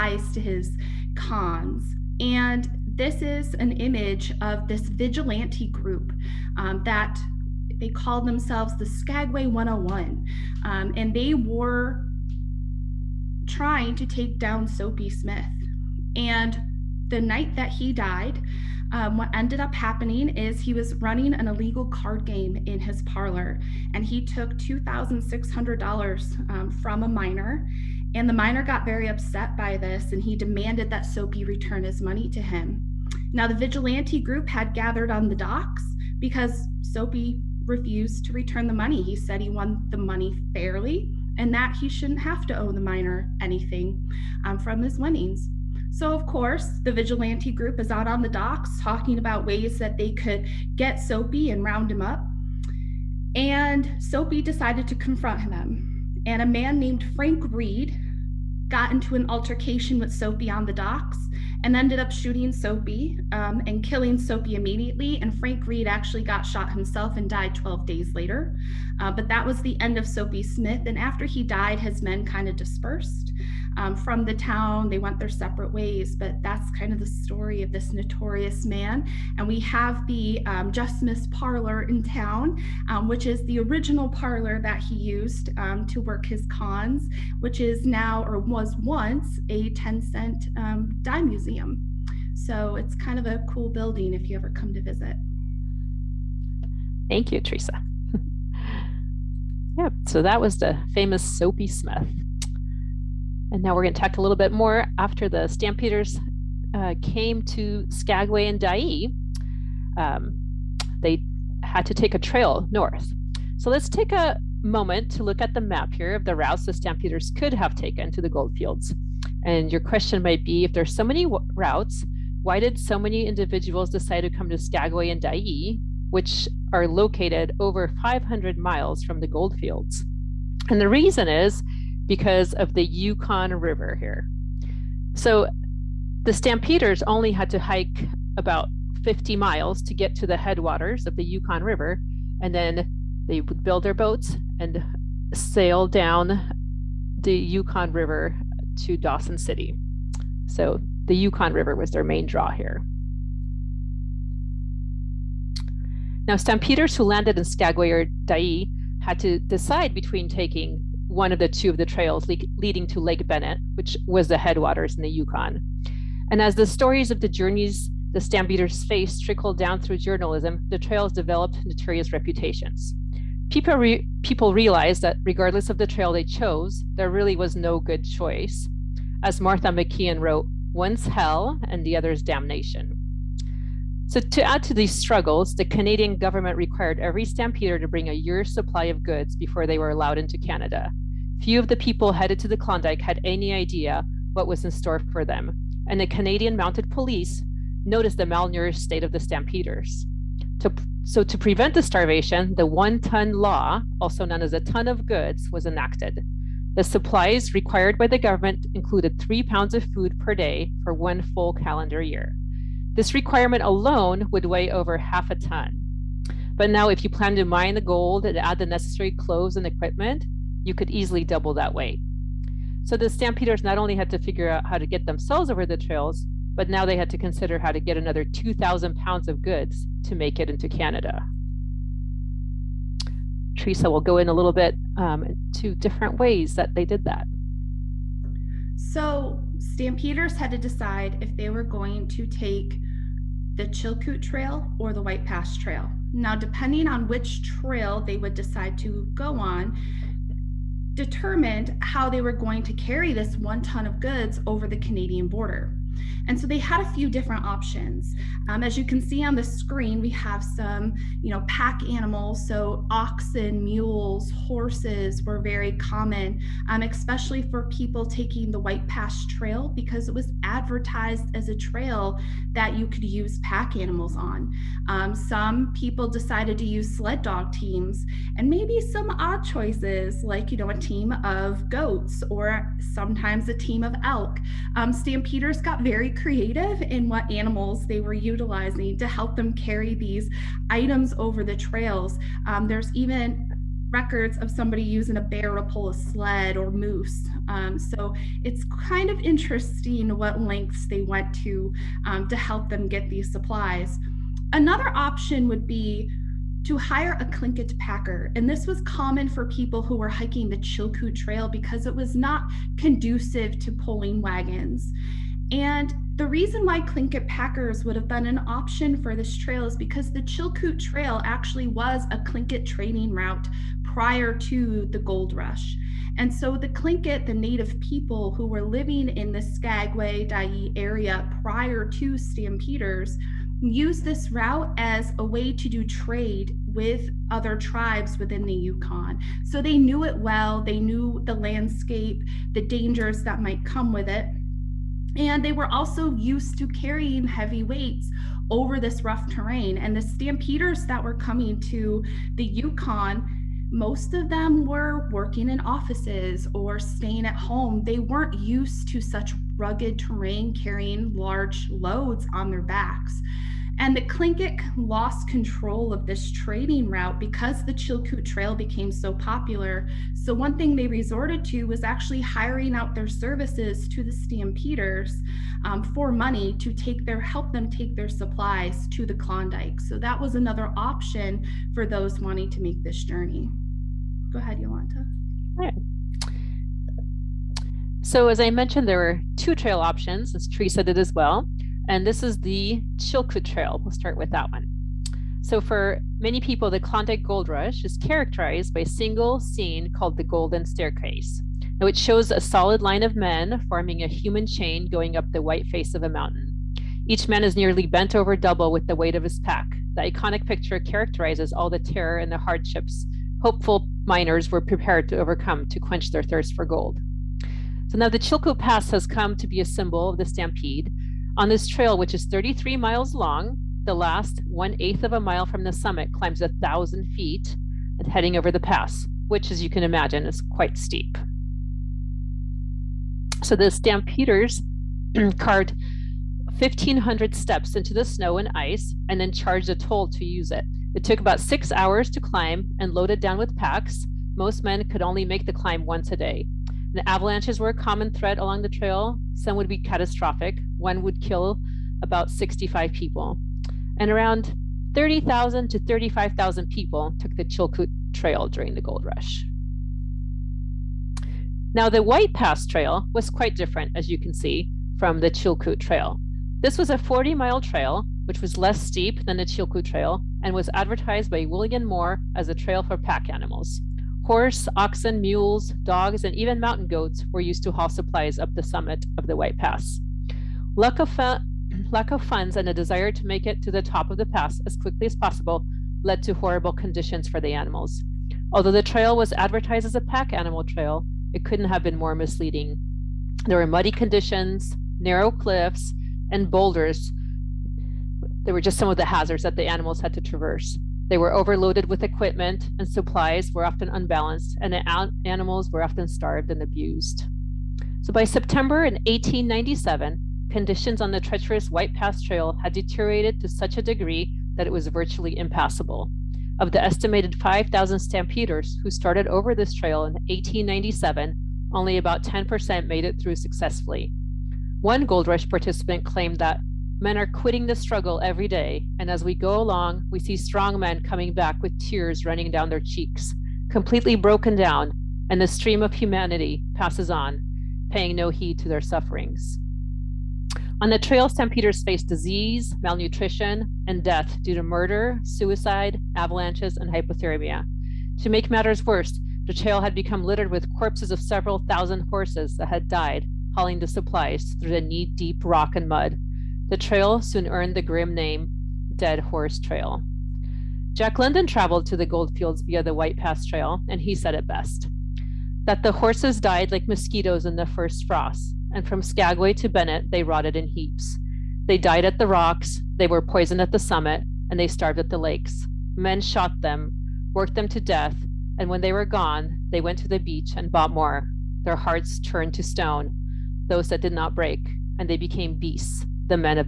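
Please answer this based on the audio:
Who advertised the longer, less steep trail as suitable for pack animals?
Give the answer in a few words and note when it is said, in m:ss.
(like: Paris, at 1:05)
William Moore, at 7:51.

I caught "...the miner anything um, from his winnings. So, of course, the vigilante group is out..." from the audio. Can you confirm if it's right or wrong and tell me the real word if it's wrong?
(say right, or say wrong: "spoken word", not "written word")
right.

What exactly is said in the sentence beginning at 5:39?
So they knew it well, they knew the landscape, the dangers that might come with it.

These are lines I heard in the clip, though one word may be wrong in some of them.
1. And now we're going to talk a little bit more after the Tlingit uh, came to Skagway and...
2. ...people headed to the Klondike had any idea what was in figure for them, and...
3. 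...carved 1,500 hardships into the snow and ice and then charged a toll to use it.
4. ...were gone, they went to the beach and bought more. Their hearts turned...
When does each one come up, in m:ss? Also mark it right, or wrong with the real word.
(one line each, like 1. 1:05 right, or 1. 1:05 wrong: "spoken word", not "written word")
1. 1:43 wrong: "Stampeders", not "Tlingit"
2. 3:11 wrong: "store", not "figure"
3. 7:15 wrong: "steps", not "hardships"
4. 9:38 right.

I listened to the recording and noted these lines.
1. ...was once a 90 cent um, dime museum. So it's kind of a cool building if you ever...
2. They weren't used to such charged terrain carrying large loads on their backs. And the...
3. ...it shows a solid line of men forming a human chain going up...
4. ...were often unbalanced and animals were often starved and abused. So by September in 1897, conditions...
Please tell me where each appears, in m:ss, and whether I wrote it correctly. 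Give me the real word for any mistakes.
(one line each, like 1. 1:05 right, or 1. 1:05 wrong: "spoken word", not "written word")
1. 1:28 wrong: "10", not "90"
2. 5:57 wrong: "rugged", not "charged"
3. 6:41 right
4. 8:23 right.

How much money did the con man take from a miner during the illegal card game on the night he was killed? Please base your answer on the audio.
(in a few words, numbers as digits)
$2,600.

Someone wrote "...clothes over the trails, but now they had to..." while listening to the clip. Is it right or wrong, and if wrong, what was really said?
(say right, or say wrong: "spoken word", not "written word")
wrong: "themselves", not "clothes".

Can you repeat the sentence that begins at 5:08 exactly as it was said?
And this was common for people who were hiking the Chilkoot Trail because it was not conducive to pulling wagons.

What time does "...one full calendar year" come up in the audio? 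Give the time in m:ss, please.
3:30.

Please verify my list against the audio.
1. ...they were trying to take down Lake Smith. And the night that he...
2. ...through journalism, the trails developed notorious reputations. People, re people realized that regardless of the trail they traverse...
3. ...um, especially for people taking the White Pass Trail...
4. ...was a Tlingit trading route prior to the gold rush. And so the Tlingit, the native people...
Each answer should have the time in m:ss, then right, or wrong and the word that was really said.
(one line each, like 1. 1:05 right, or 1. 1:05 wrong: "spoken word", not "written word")
1. 0:11 wrong: "Soapy", not "Lake"
2. 2:49 wrong: "chose", not "traverse"
3. 4:26 right
4. 5:21 right.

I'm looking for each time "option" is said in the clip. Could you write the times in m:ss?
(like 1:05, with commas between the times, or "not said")
4:17, 5:04, 5:18, 6:20, 6:29.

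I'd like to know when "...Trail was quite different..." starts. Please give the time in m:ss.
7:42.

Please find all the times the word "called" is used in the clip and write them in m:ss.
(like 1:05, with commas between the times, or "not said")
0:07, 6:39.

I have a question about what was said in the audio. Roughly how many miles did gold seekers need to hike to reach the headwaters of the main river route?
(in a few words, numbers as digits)
50.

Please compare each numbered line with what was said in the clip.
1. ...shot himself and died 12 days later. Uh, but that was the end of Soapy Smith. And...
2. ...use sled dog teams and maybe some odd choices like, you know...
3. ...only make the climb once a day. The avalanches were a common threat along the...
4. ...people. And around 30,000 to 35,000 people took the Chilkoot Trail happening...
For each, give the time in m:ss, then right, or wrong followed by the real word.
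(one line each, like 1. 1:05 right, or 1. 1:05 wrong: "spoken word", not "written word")
1. 1:06 right
2. 4:36 right
3. 7:25 right
4. 7:32 wrong: "during", not "happening".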